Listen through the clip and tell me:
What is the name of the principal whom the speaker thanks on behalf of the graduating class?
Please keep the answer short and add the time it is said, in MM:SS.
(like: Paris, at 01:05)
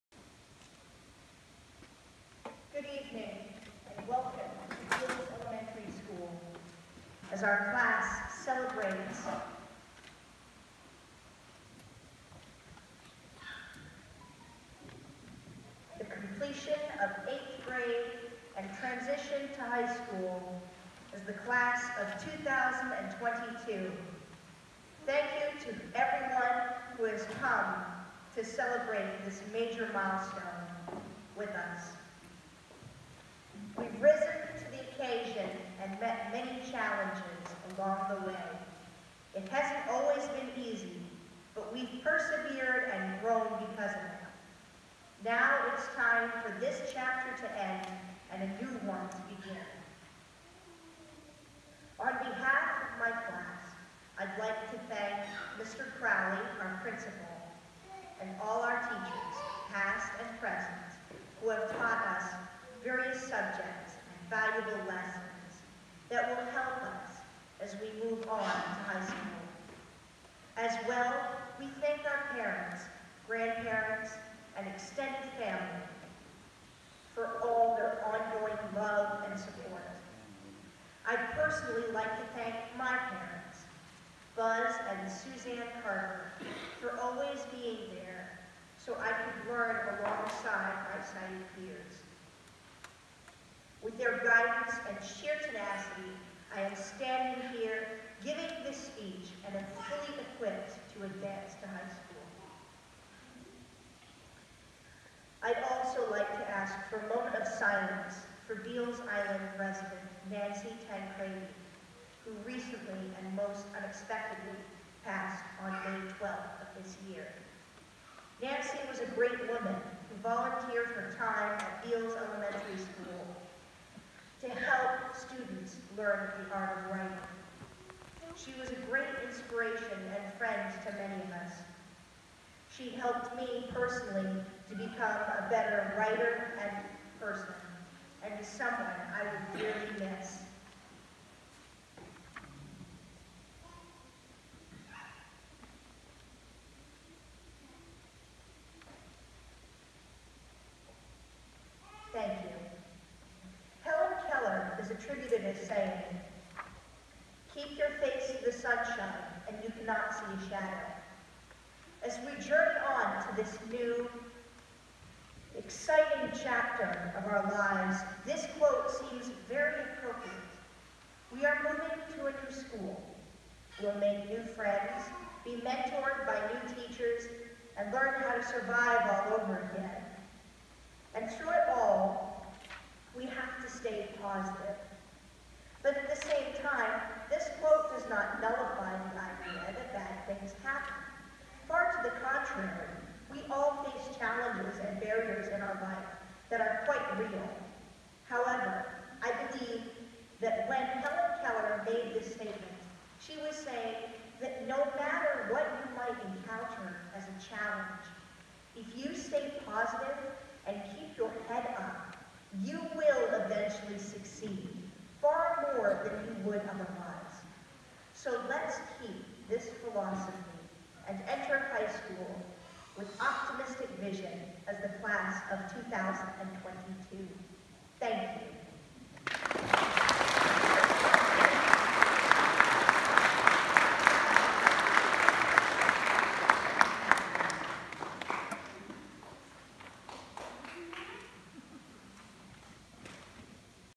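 Mr. Crowley, at 00:55.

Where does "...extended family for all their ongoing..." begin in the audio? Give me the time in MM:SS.
01:14.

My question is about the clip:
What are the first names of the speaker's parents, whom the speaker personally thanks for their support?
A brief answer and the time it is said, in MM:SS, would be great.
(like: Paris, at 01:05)
Buzz and Suzanne, at 01:24.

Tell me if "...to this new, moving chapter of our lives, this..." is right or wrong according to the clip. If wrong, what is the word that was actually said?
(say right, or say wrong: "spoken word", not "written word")
wrong: "exciting", not "moving".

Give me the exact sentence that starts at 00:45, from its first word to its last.
Now it's time for this chapter to end and a new one to begin.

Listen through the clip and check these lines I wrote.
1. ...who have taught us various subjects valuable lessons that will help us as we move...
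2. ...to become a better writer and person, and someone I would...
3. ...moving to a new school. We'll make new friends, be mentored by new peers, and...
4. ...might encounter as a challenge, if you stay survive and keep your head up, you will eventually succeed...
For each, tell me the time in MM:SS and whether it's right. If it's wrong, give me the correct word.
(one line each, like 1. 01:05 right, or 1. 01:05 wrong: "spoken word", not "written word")
1. 01:01 right
2. 02:14 right
3. 02:51 wrong: "teachers", not "peers"
4. 03:25 wrong: "positive", not "survive".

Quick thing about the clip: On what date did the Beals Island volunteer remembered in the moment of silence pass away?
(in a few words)
May 12th.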